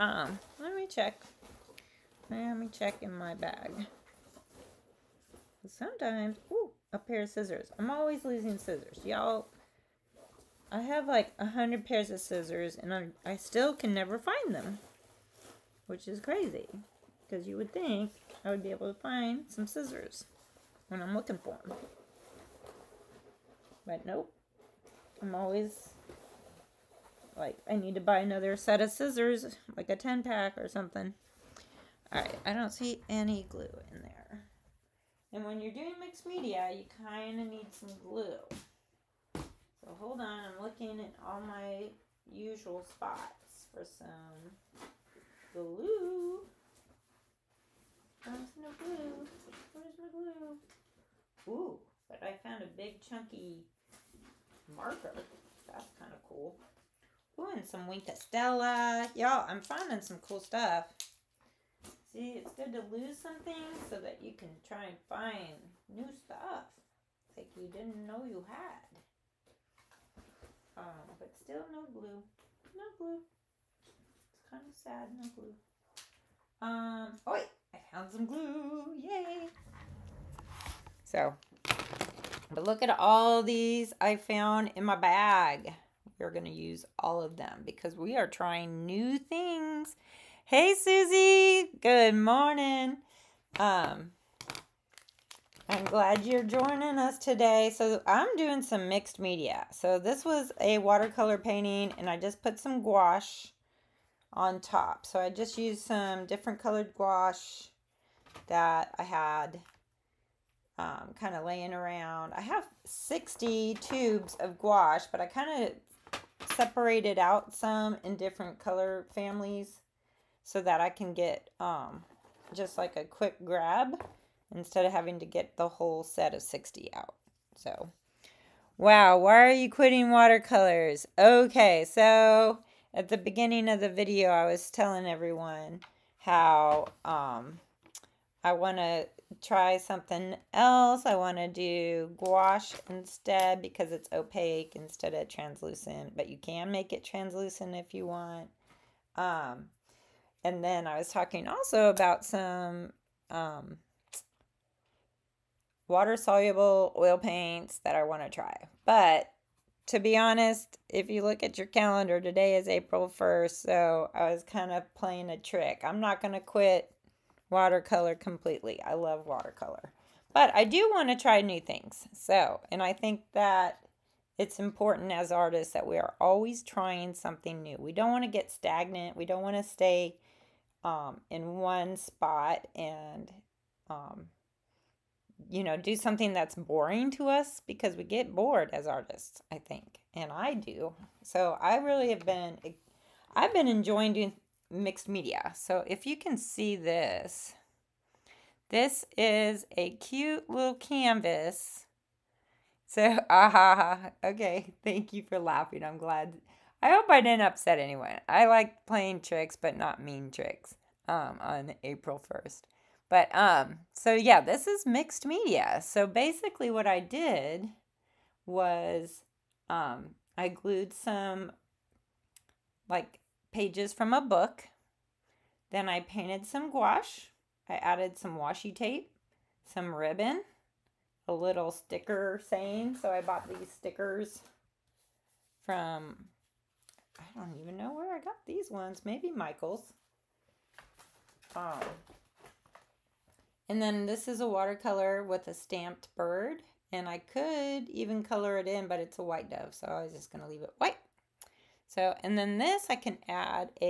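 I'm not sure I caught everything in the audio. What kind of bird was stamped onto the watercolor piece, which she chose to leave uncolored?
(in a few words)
White dove.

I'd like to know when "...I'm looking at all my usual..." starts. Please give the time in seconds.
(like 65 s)
40 s.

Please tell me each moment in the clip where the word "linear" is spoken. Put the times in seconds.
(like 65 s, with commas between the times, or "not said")
not said.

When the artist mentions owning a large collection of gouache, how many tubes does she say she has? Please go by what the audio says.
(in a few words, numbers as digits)
60.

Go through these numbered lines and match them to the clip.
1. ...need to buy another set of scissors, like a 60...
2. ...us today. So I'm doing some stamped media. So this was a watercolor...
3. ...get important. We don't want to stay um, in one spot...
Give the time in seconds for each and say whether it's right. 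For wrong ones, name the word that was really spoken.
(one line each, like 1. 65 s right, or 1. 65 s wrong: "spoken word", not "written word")
1. 27 s wrong: "10", not "60"
2. 96 s wrong: "mixed", not "stamped"
3. 178 s wrong: "stagnant", not "important".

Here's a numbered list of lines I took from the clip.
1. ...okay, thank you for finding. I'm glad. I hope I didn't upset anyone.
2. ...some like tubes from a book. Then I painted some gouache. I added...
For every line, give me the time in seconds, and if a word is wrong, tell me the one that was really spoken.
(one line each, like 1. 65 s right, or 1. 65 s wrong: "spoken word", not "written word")
1. 204 s wrong: "laughing", not "finding"
2. 220 s wrong: "pages", not "tubes".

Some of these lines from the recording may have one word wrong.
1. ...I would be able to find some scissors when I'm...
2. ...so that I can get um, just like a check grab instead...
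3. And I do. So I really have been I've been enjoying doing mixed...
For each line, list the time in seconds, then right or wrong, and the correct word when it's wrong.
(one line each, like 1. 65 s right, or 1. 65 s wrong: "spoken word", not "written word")
1. 18 s right
2. 120 s wrong: "quick", not "check"
3. 190 s right.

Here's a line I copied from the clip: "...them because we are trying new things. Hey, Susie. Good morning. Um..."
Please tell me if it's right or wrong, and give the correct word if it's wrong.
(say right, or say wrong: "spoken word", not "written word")
right.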